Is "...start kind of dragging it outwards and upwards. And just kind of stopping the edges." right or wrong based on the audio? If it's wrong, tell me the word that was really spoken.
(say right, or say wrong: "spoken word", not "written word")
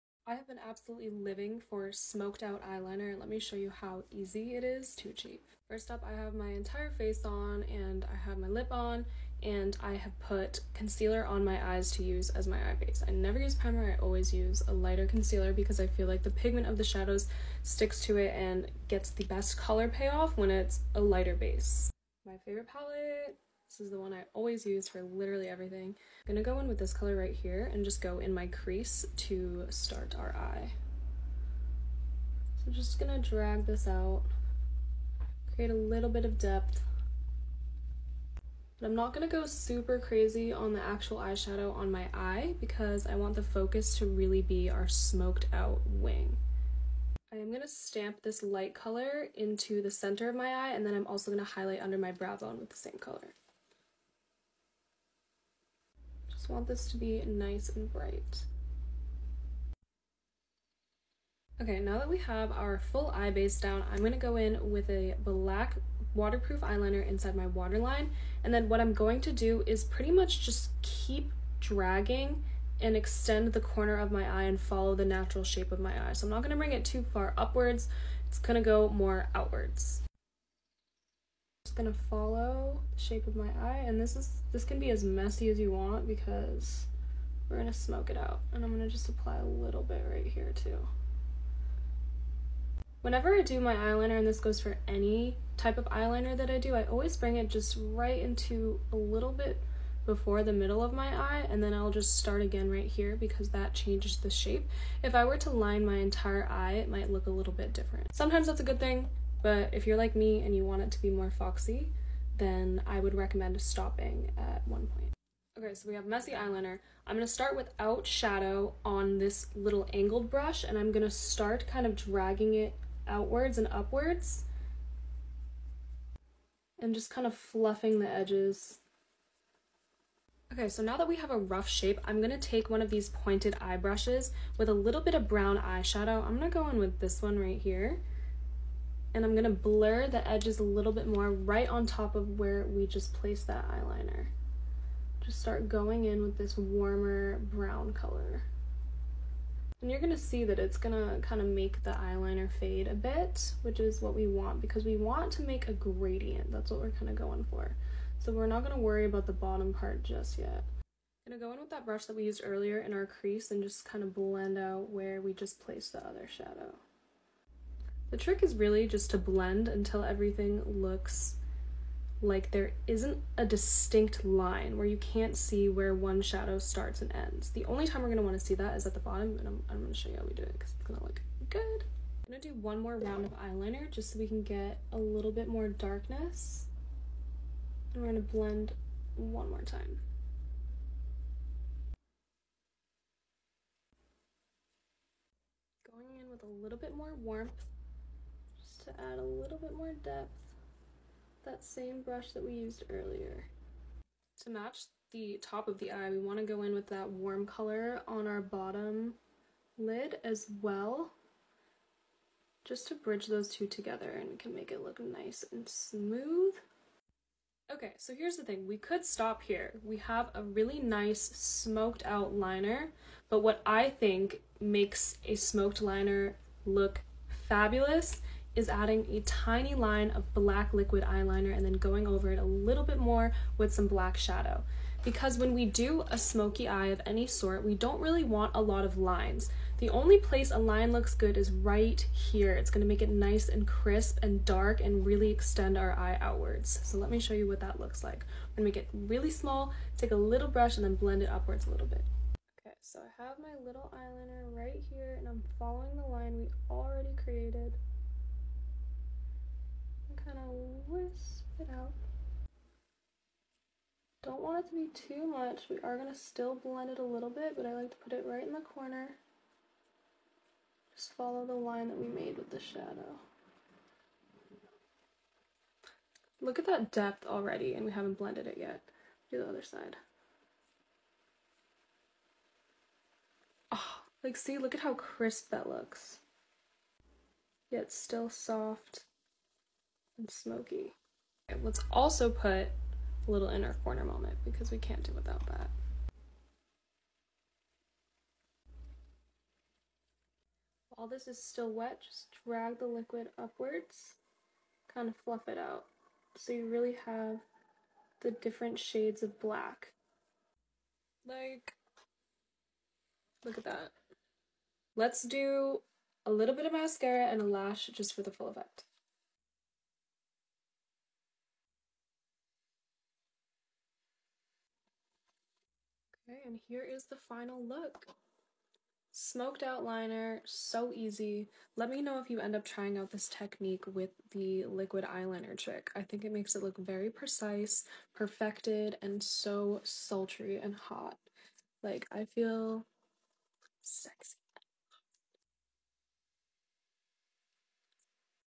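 wrong: "fluffing", not "stopping".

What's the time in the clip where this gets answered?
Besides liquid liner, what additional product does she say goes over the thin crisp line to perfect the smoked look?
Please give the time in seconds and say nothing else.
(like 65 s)
233 s.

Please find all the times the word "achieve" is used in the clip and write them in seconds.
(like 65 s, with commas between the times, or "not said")
5 s.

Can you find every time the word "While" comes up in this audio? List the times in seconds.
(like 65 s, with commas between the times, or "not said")
300 s.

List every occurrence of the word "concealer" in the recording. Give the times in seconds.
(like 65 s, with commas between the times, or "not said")
10 s, 15 s.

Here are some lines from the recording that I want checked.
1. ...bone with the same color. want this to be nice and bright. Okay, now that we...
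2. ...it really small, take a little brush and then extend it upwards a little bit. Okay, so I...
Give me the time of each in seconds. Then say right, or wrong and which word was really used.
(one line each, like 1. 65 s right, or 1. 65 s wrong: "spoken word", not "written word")
1. 52 s right
2. 248 s wrong: "blend", not "extend".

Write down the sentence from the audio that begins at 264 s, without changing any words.
Don't want it to be too much.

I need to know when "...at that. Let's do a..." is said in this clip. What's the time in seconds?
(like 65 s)
313 s.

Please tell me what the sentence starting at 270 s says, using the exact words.
Just follow the line that we made with the shadow.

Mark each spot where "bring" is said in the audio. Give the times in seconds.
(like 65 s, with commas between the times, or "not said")
76 s, 97 s.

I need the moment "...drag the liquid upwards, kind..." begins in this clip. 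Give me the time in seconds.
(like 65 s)
302 s.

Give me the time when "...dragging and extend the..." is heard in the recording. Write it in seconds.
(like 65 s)
71 s.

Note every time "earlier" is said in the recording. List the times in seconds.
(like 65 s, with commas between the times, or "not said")
162 s, 202 s.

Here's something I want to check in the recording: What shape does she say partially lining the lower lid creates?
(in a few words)
foxy.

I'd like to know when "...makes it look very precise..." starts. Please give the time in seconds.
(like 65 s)
336 s.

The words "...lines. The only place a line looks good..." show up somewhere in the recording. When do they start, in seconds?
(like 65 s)
238 s.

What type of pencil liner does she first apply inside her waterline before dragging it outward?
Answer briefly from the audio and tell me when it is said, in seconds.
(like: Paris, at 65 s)
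black waterproof eyeliner, at 65 s.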